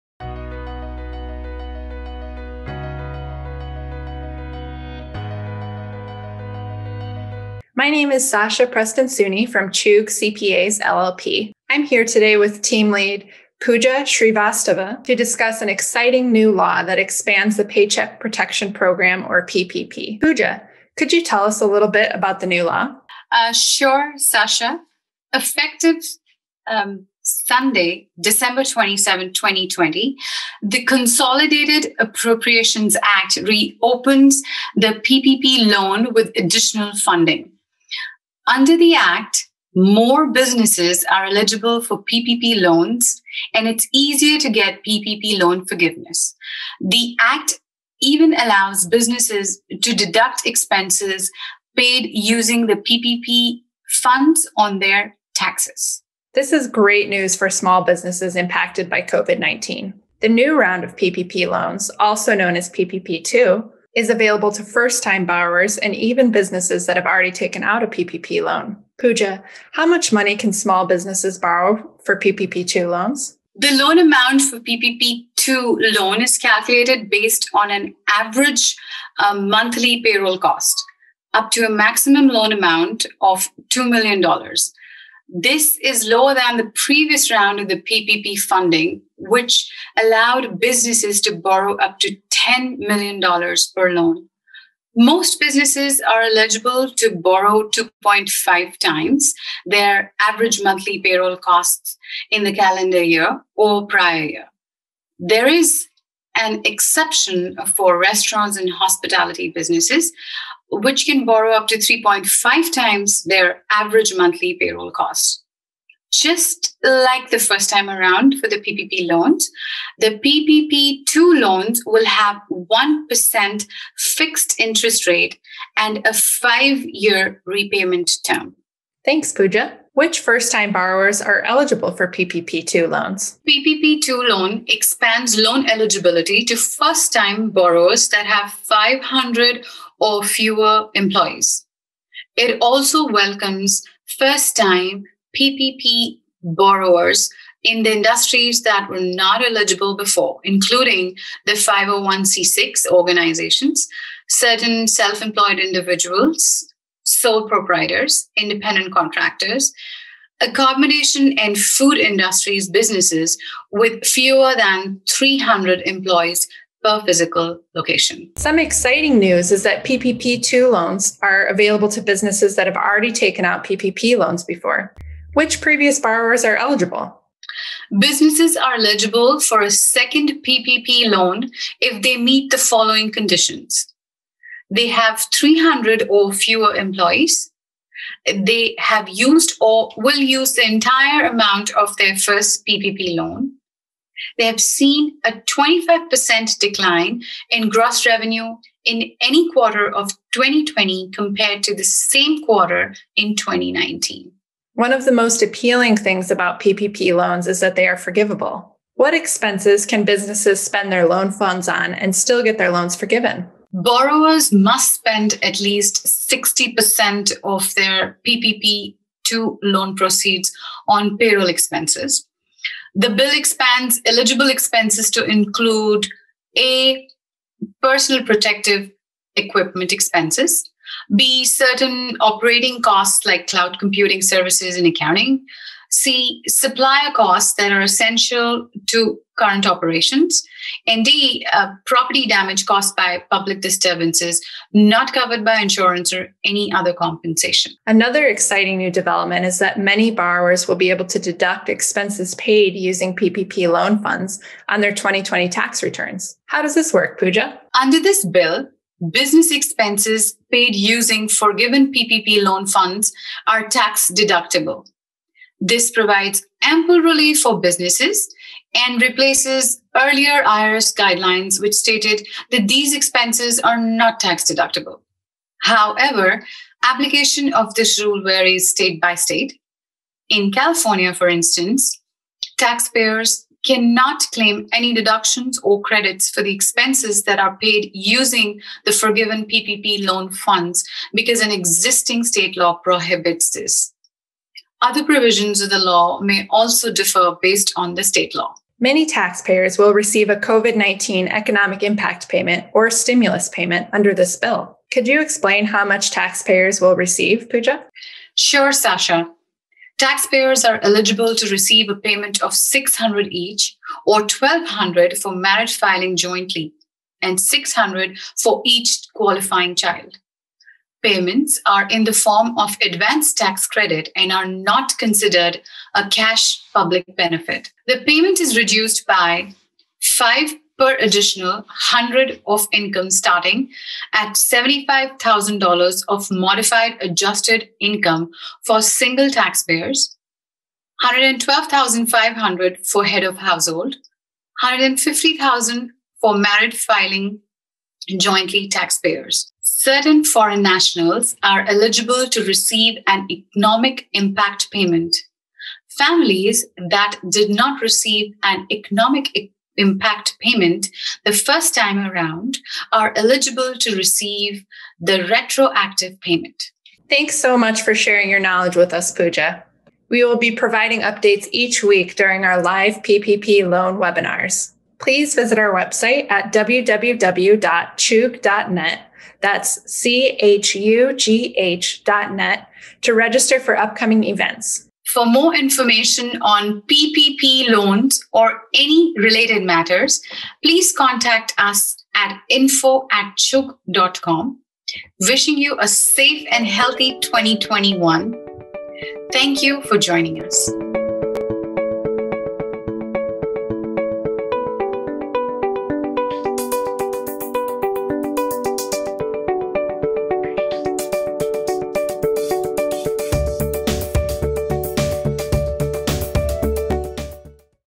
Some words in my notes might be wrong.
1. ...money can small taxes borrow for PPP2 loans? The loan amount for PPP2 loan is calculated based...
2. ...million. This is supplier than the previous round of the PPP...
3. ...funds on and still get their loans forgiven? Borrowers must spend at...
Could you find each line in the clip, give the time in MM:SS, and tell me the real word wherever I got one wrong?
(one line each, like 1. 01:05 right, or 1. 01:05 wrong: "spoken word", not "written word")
1. 01:10 wrong: "businesses", not "taxes"
2. 01:23 wrong: "lower", not "supplier"
3. 03:31 right.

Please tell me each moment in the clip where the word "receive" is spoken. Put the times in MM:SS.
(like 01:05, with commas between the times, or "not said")
04:59, 05:06, 05:11, 05:52, 05:57, 06:03.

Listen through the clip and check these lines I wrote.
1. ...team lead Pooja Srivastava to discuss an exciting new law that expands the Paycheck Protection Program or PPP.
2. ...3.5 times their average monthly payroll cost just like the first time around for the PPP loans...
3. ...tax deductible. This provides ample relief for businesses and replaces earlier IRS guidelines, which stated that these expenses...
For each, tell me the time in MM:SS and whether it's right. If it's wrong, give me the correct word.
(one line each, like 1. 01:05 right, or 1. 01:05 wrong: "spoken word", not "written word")
1. 00:12 right
2. 01:51 right
3. 04:23 right.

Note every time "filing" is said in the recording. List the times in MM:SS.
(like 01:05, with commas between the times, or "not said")
05:15, 05:46.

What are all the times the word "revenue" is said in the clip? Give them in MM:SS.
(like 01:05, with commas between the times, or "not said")
03:18.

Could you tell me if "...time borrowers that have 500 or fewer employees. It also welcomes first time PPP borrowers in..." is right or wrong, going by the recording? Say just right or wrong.
right.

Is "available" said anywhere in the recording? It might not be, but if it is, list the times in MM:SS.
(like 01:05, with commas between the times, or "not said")
01:04, 02:51.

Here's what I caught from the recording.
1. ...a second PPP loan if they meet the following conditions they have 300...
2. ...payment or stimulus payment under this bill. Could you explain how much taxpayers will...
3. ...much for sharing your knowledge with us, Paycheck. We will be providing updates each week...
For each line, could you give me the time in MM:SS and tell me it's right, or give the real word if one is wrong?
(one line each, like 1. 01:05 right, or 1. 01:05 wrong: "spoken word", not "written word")
1. 02:59 right
2. 05:02 right
3. 06:07 wrong: "Pooja", not "Paycheck".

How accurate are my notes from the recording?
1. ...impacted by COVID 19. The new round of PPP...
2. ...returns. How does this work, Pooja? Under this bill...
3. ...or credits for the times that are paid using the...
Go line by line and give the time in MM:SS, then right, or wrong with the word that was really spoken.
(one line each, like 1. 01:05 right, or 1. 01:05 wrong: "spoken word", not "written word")
1. 00:58 right
2. 04:15 right
3. 04:45 wrong: "expenses", not "times".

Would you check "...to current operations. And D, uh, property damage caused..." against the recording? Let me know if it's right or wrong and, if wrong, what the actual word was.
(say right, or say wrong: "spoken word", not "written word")
right.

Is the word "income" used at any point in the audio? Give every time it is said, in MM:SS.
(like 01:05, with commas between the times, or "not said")
05:32, 05:37.